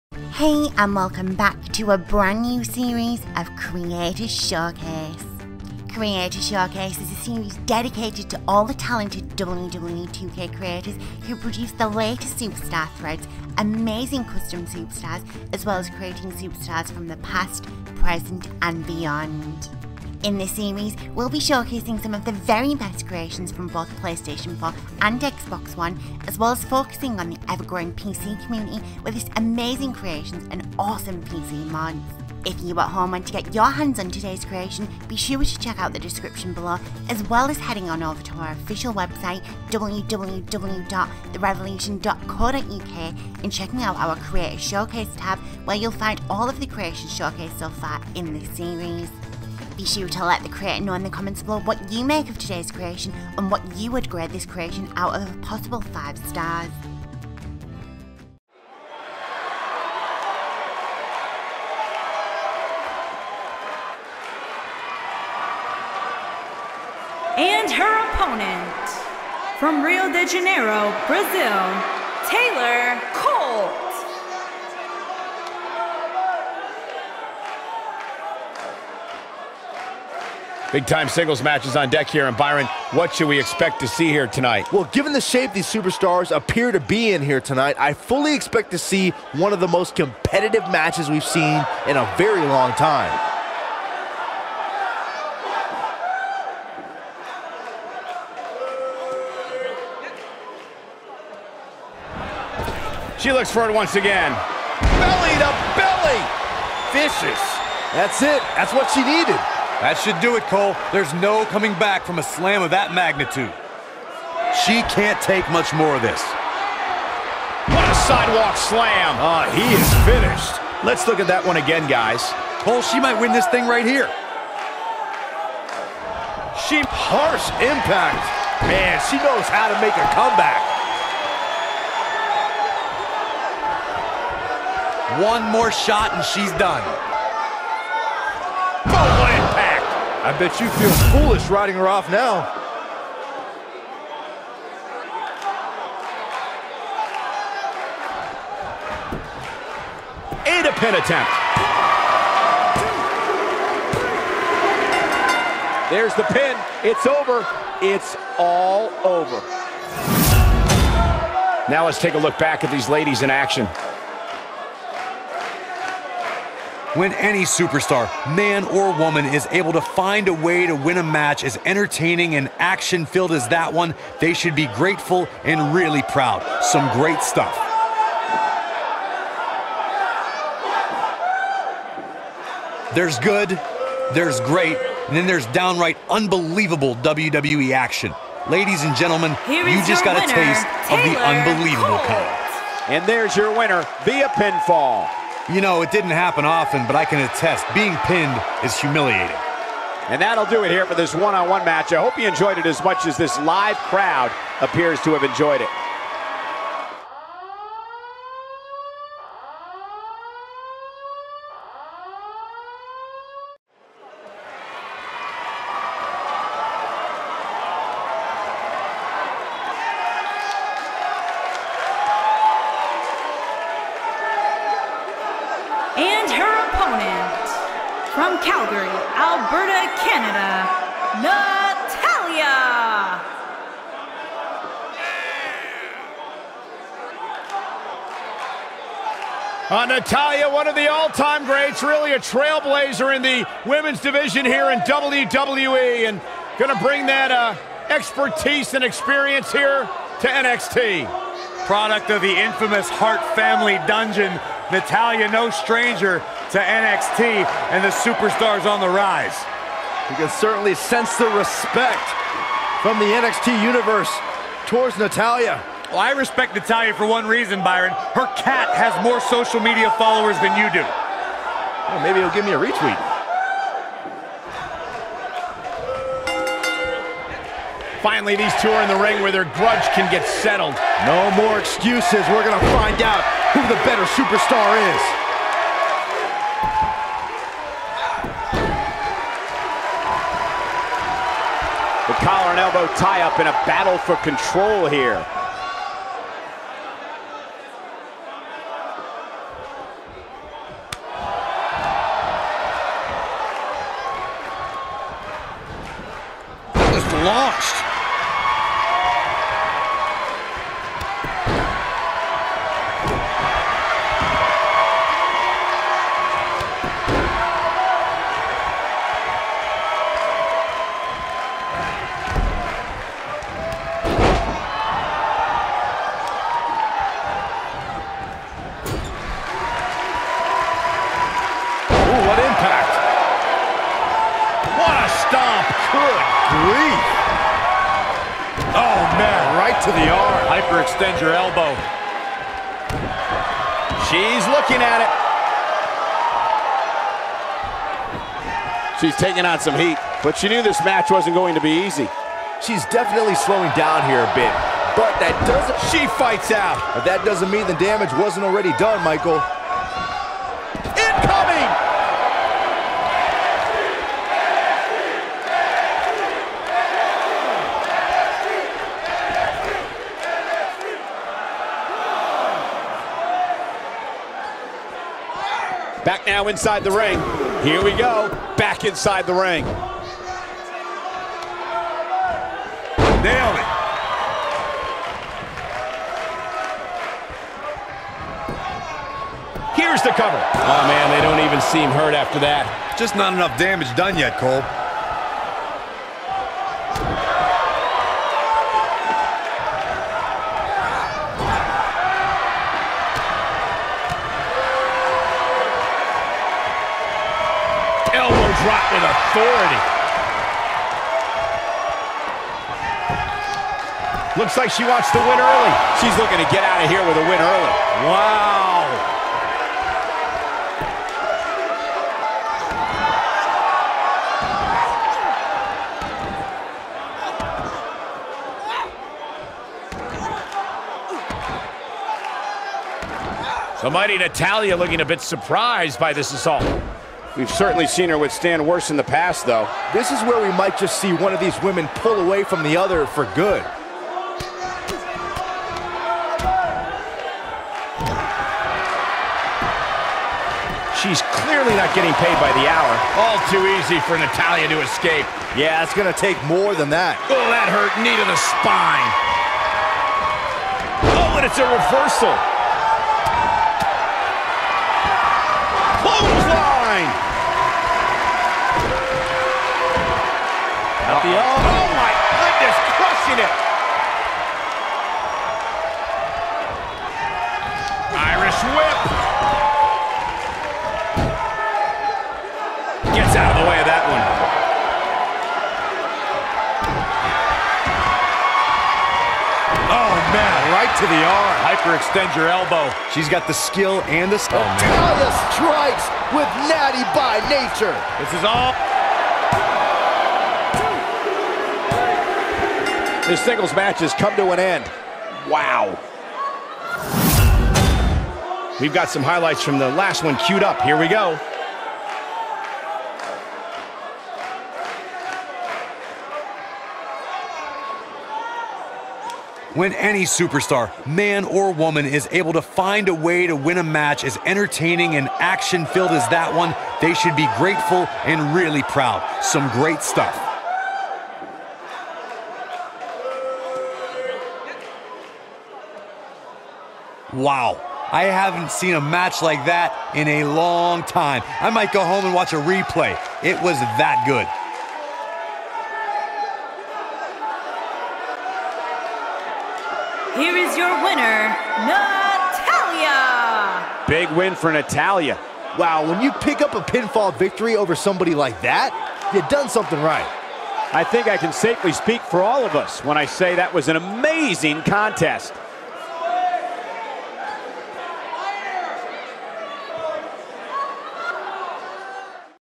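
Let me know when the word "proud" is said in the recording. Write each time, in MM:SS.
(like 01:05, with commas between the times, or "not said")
02:56, 08:48.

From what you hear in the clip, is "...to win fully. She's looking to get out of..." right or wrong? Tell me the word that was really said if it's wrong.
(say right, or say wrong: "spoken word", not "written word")
wrong: "early", not "fully".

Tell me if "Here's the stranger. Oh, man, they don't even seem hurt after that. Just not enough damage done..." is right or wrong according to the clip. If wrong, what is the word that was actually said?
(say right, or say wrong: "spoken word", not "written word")
wrong: "cover", not "stranger".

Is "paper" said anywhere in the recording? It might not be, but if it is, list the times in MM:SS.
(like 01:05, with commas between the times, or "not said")
not said.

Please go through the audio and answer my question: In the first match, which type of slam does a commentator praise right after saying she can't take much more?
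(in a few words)
sidewalk slam.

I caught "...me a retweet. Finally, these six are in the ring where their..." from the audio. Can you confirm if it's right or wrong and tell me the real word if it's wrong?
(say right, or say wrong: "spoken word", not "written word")
wrong: "two", not "six".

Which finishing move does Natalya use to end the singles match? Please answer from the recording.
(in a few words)
Natty by Nature.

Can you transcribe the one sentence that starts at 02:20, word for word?
I bet you feel foolish riding her off now.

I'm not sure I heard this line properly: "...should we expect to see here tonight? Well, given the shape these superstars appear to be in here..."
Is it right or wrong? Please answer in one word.
right.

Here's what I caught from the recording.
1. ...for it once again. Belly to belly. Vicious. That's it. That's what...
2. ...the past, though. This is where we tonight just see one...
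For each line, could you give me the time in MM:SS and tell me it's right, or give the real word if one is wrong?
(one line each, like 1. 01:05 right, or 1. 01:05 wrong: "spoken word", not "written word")
1. 01:43 right
2. 07:18 wrong: "might", not "tonight".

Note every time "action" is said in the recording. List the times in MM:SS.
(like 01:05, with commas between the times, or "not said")
02:43, 02:52, 03:07, 08:45.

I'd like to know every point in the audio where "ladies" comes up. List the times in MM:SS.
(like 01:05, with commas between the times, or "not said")
02:42, 03:08.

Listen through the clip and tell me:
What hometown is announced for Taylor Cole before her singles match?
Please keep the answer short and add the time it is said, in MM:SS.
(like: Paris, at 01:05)
Rio de Janeiro, Brazil, at 01:09.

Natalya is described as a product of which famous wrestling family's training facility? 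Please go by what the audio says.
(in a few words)
Hart family dungeon.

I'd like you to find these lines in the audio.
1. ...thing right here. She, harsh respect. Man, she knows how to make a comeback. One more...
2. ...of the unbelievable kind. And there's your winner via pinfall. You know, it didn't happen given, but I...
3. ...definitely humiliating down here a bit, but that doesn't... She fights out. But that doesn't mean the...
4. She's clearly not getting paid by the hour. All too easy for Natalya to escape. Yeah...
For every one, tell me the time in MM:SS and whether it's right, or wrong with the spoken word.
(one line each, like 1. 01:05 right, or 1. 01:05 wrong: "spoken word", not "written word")
1. 02:03 wrong: "impact", not "respect"
2. 03:10 wrong: "often", not "given"
3. 05:52 wrong: "slowing", not "humiliating"
4. 07:30 right.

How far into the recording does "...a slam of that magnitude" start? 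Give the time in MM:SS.
01:52.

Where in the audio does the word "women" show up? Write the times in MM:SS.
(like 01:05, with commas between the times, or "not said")
04:03, 07:21.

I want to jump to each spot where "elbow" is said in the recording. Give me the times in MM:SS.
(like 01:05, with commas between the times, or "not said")
04:52, 05:41, 08:12.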